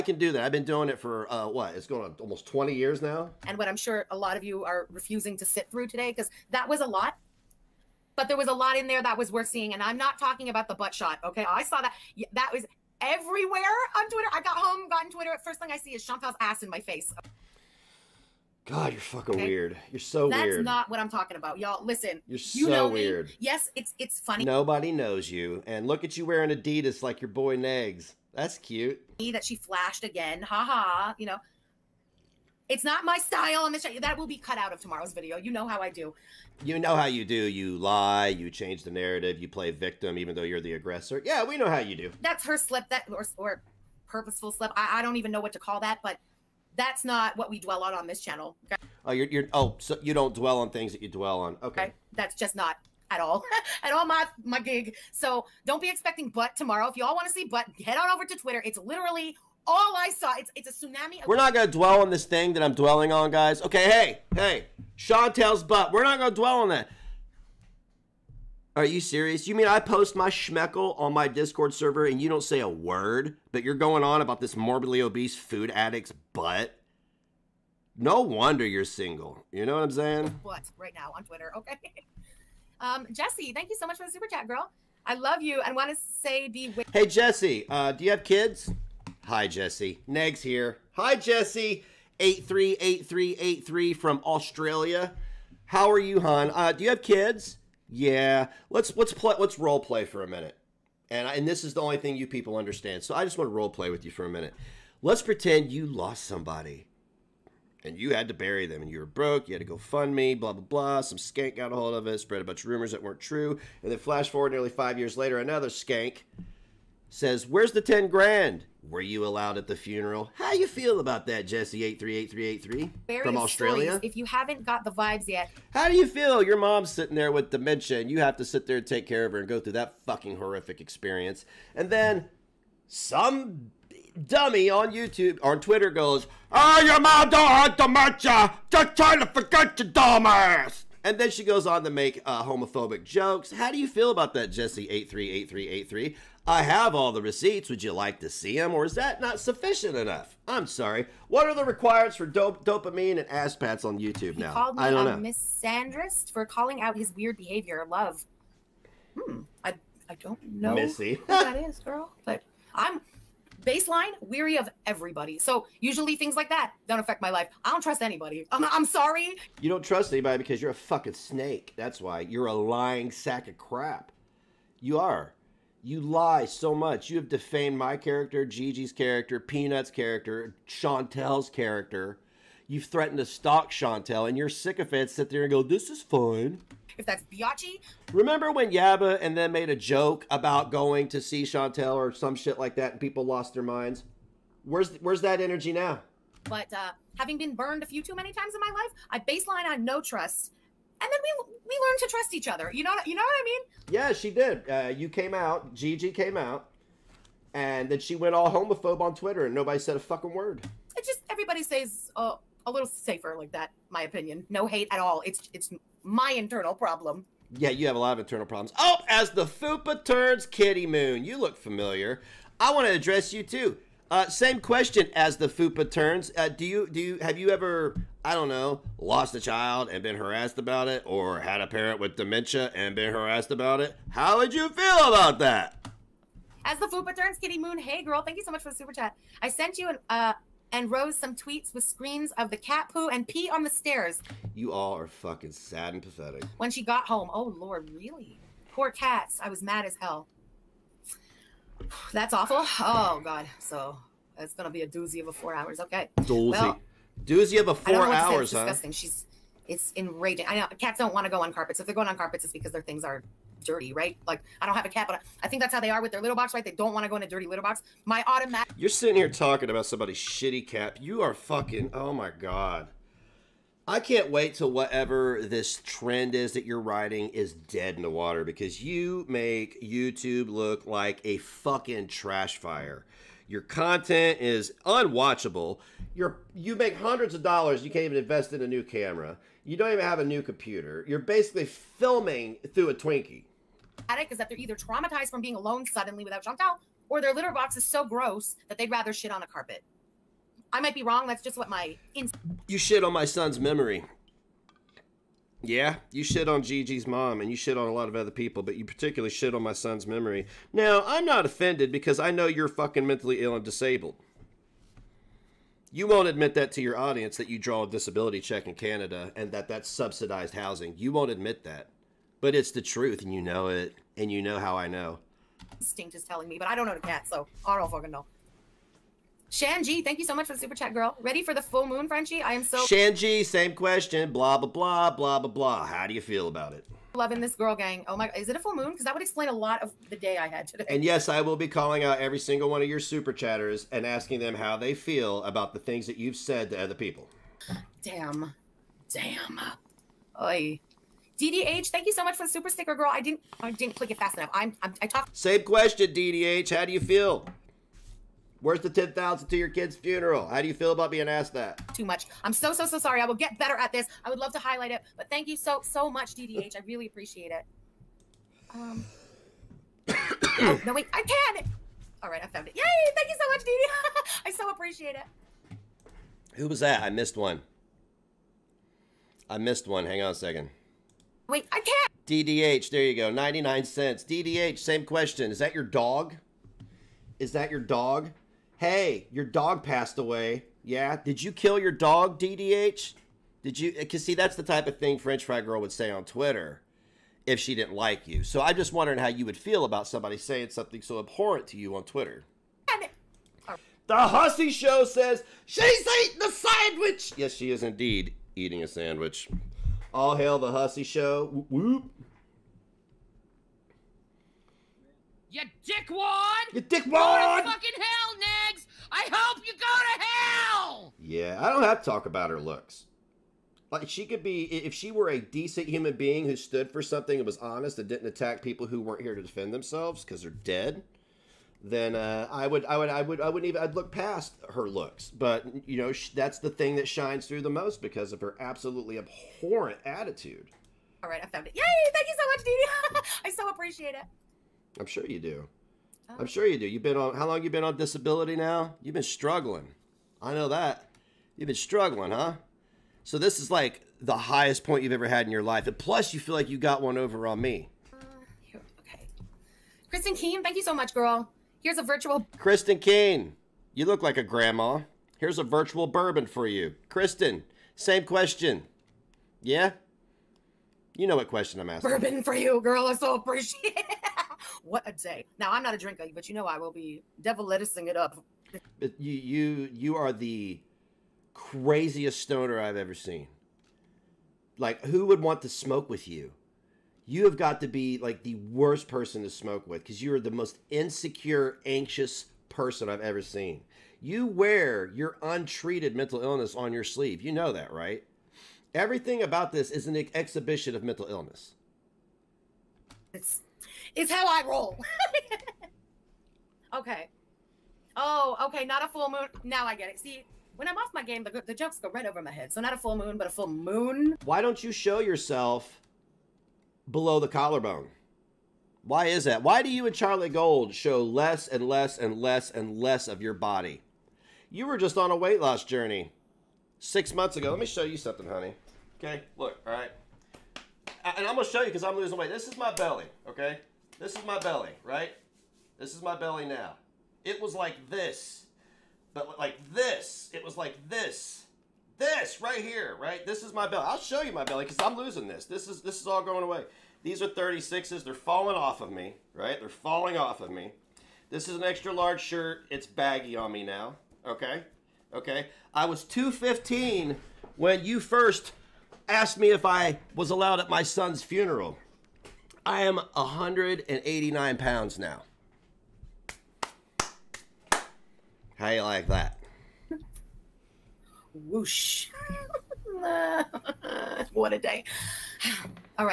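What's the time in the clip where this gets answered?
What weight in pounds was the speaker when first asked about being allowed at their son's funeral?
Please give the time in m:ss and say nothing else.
9:16.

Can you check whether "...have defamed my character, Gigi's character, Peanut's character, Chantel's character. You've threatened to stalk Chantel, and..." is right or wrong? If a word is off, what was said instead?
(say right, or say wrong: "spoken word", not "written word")
right.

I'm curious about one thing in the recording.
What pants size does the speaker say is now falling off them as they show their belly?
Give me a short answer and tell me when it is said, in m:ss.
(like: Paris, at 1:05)
36s, at 9:07.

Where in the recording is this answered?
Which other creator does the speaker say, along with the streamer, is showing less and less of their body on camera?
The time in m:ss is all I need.
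8:40.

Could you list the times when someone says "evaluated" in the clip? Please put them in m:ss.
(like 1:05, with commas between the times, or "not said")
not said.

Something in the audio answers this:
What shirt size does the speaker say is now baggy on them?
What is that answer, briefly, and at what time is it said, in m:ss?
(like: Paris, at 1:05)
extra large, at 9:11.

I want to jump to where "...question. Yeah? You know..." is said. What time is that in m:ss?
7:48.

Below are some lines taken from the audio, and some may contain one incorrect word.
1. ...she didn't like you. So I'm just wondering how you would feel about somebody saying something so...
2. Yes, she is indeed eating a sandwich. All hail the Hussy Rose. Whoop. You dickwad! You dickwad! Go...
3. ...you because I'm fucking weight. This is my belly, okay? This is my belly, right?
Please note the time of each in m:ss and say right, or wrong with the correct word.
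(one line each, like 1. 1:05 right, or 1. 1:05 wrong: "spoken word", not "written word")
1. 6:37 right
2. 6:47 wrong: "Show", not "Rose"
3. 8:51 wrong: "losing", not "fucking".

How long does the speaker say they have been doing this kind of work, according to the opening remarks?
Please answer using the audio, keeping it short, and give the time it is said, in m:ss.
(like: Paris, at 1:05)
almost 20 years, at 0:02.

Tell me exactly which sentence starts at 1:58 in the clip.
Were you allowed at the funeral?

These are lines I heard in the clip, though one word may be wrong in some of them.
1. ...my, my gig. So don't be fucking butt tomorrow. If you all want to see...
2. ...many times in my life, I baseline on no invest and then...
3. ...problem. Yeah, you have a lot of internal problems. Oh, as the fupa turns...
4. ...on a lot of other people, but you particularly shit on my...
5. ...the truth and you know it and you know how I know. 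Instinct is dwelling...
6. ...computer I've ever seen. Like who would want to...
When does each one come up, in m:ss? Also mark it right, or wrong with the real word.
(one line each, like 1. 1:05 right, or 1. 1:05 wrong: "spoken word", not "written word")
1. 0:54 wrong: "expecting", not "fucking"
2. 3:18 wrong: "trust", not "invest"
3. 3:36 right
4. 5:07 right
5. 5:22 wrong: "telling", not "dwelling"
6. 8:02 wrong: "stoner", not "computer".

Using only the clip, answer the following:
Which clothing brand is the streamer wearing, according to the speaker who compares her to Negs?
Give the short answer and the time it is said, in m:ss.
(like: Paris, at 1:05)
Adidas, at 0:26.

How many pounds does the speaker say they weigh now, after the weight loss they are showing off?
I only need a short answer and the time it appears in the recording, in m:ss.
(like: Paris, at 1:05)
189, at 9:23.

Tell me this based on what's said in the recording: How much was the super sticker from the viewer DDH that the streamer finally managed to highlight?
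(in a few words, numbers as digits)
99 cents.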